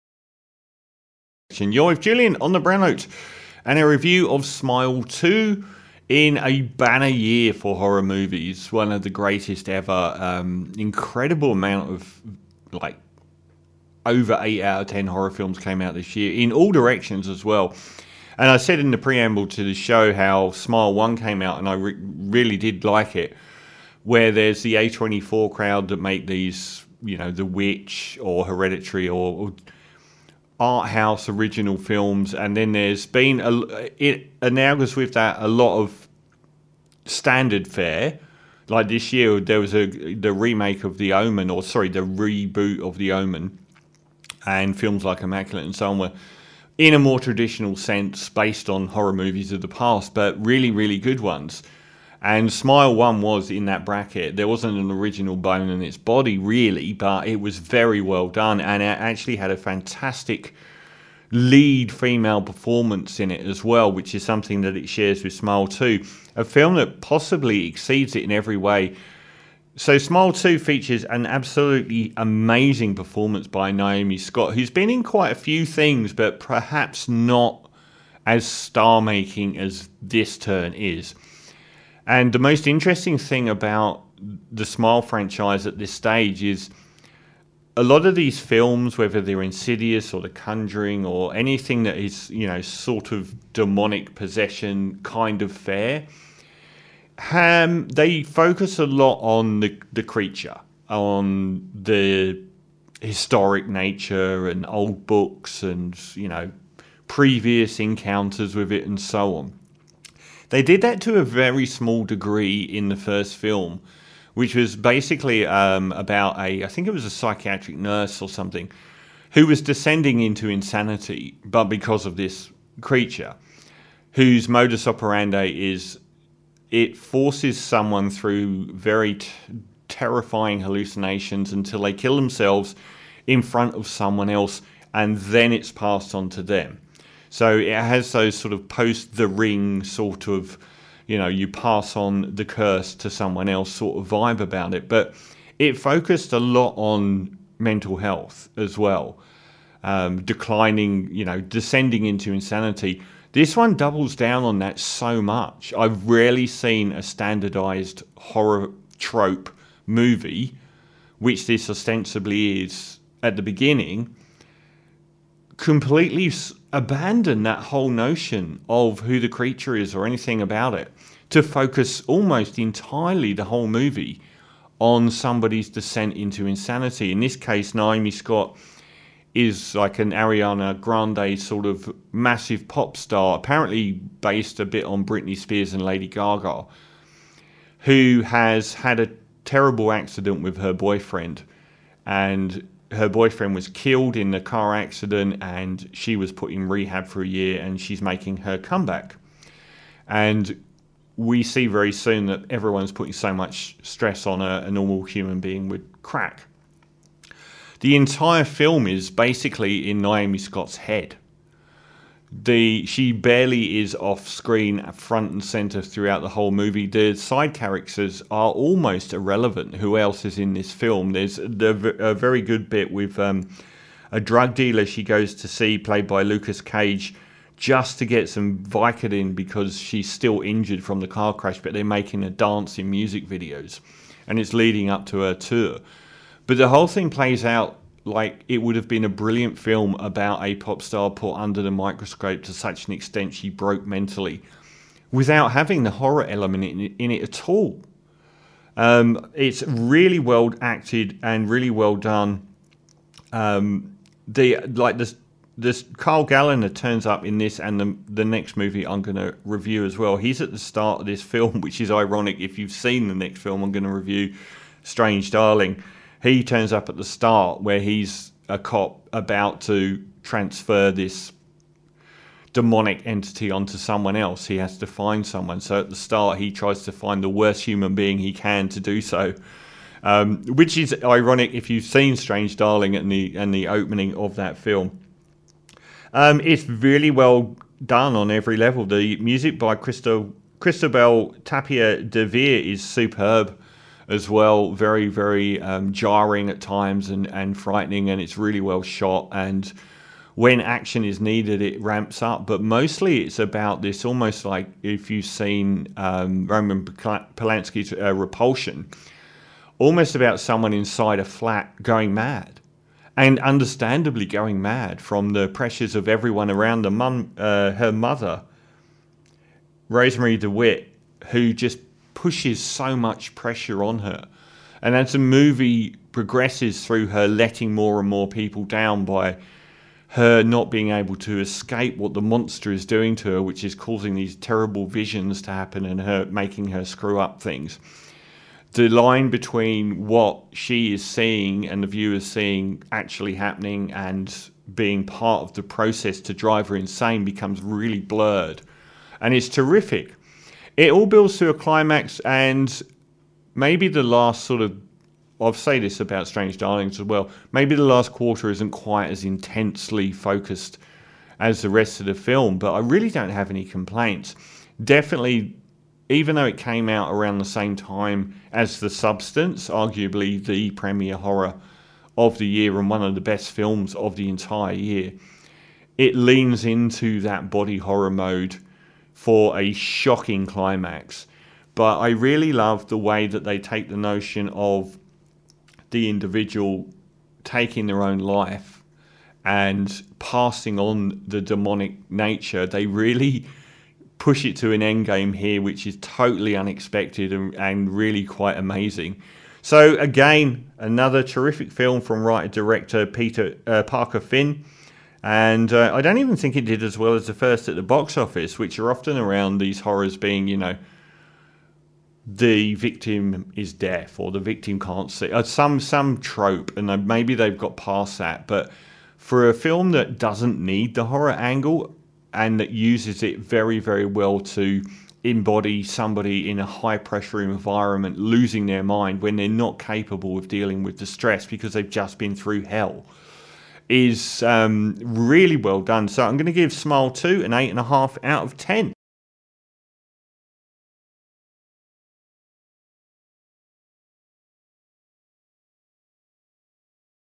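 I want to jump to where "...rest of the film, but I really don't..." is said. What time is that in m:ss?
6:01.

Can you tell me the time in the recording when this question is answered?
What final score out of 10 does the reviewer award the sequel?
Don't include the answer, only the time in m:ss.
7:17.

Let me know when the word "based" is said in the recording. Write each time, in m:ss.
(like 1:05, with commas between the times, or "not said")
0:48, 3:03.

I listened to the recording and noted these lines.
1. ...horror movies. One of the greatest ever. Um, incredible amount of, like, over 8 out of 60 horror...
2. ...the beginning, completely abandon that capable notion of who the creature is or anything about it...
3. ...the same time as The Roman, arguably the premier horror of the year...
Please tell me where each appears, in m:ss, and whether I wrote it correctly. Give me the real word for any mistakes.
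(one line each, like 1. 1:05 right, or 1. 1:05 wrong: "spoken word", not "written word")
1. 0:07 wrong: "10", not "60"
2. 2:43 wrong: "whole", not "capable"
3. 6:07 wrong: "Substance", not "Roman".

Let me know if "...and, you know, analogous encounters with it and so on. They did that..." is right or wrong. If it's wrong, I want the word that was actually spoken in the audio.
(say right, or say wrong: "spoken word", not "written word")
wrong: "previous", not "analogous".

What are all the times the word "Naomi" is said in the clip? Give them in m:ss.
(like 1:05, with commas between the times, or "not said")
1:13, 2:57, 3:30.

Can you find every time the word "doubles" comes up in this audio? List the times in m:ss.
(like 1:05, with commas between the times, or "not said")
2:33.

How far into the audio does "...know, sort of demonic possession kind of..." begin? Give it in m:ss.
1:32.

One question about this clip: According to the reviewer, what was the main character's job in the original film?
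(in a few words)
psychiatric nurse.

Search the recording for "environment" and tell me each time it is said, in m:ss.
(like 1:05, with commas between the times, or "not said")
7:07.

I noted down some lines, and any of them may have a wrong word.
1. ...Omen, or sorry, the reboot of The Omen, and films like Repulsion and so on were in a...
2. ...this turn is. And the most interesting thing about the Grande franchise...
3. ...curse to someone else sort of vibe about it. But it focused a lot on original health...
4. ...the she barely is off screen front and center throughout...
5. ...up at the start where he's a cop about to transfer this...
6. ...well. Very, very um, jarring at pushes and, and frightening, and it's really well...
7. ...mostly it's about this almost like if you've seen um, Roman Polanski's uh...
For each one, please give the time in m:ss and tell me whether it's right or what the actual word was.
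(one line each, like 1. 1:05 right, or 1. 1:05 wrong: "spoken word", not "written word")
1. 0:41 wrong: "Immaculate", not "Repulsion"
2. 1:20 wrong: "Smile", not "Grande"
3. 2:22 wrong: "mental", not "original"
4. 3:32 right
5. 4:26 right
6. 4:54 wrong: "times", not "pushes"
7. 5:02 right.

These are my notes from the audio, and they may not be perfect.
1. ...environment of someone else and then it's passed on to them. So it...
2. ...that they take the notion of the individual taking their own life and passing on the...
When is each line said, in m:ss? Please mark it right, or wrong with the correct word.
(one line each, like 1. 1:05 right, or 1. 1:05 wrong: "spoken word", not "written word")
1. 2:13 wrong: "front", not "environment"
2. 6:23 right.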